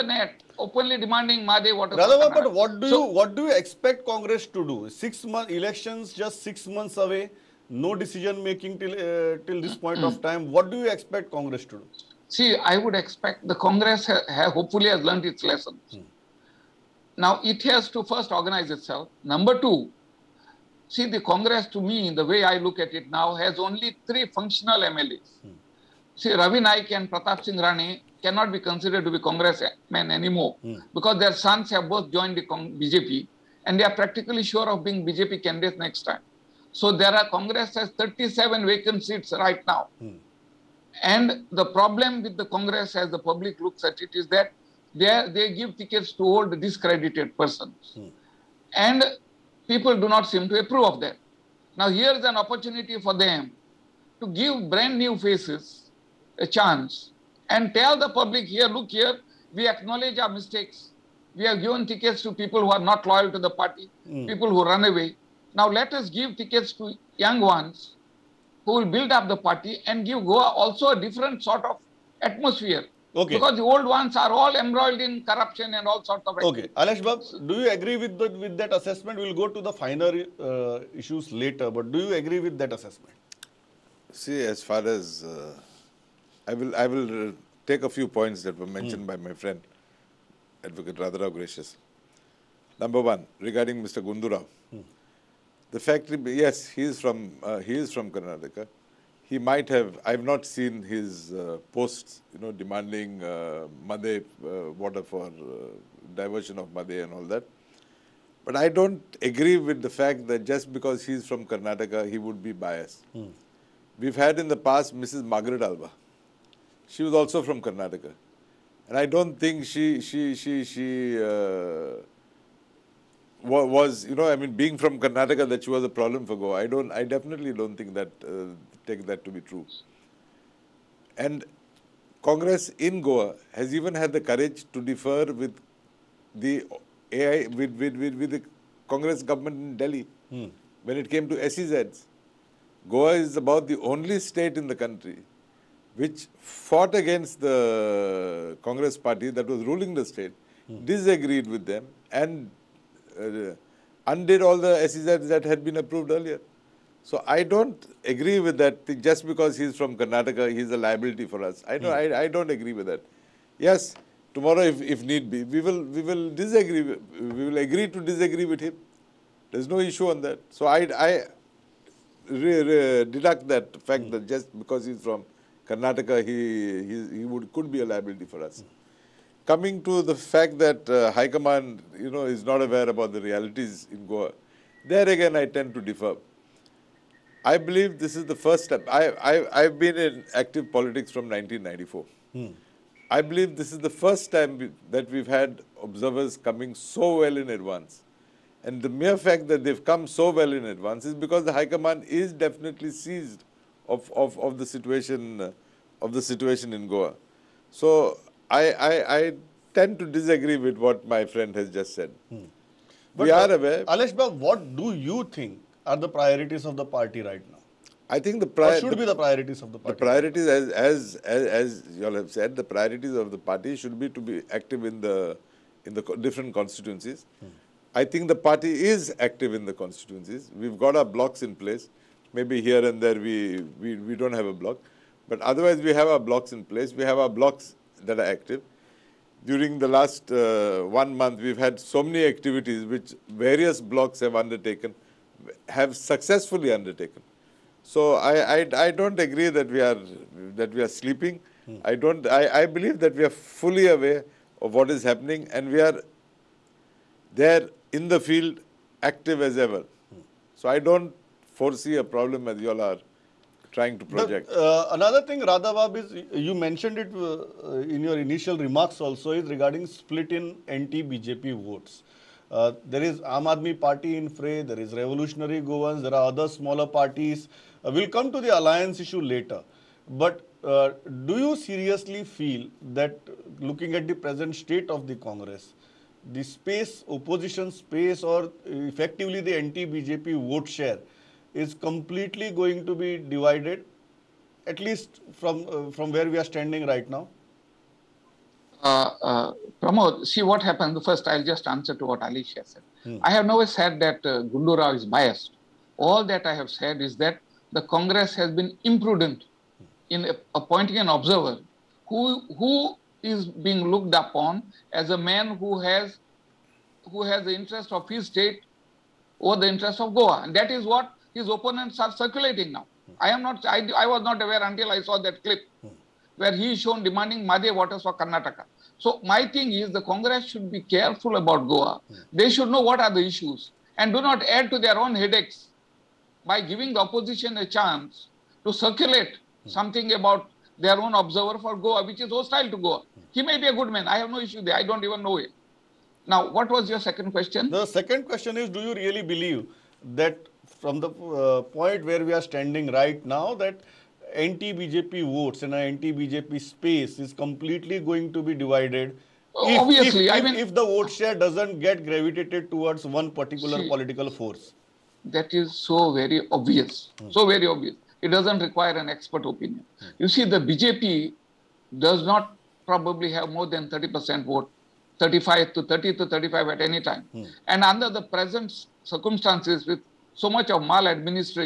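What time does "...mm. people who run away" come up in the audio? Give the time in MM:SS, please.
01:04.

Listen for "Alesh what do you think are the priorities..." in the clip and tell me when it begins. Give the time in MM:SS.
03:33.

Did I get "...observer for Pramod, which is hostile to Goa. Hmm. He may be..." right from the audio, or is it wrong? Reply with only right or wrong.
wrong.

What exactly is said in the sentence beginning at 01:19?
We'll go to the finer uh, issues later, but do you agree with that assessment?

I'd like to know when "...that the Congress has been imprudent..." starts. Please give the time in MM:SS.
05:07.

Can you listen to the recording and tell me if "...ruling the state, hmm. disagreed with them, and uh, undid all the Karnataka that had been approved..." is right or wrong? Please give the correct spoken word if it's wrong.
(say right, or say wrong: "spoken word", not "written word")
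wrong: "SEZs", not "Karnataka".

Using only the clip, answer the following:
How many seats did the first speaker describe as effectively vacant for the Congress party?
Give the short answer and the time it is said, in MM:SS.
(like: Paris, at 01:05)
37, at 00:37.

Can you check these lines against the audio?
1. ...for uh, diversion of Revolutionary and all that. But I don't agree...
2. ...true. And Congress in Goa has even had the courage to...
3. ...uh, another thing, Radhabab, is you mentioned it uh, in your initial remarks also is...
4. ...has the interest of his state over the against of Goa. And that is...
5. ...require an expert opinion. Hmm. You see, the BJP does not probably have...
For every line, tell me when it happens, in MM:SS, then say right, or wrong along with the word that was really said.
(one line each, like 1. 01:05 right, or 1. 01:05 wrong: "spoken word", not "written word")
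1. 01:45 wrong: "Mhadei", not "Revolutionary"
2. 02:09 right
3. 04:24 right
4. 05:17 wrong: "interest", not "against"
5. 06:08 right.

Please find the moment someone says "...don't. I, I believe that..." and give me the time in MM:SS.
04:11.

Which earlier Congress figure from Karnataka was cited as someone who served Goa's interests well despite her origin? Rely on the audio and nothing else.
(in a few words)
Margaret Alva.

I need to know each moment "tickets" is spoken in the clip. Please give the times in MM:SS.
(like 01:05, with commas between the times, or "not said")
00:45, 01:01, 01:06.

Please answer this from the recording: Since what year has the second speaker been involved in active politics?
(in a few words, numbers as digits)
1994.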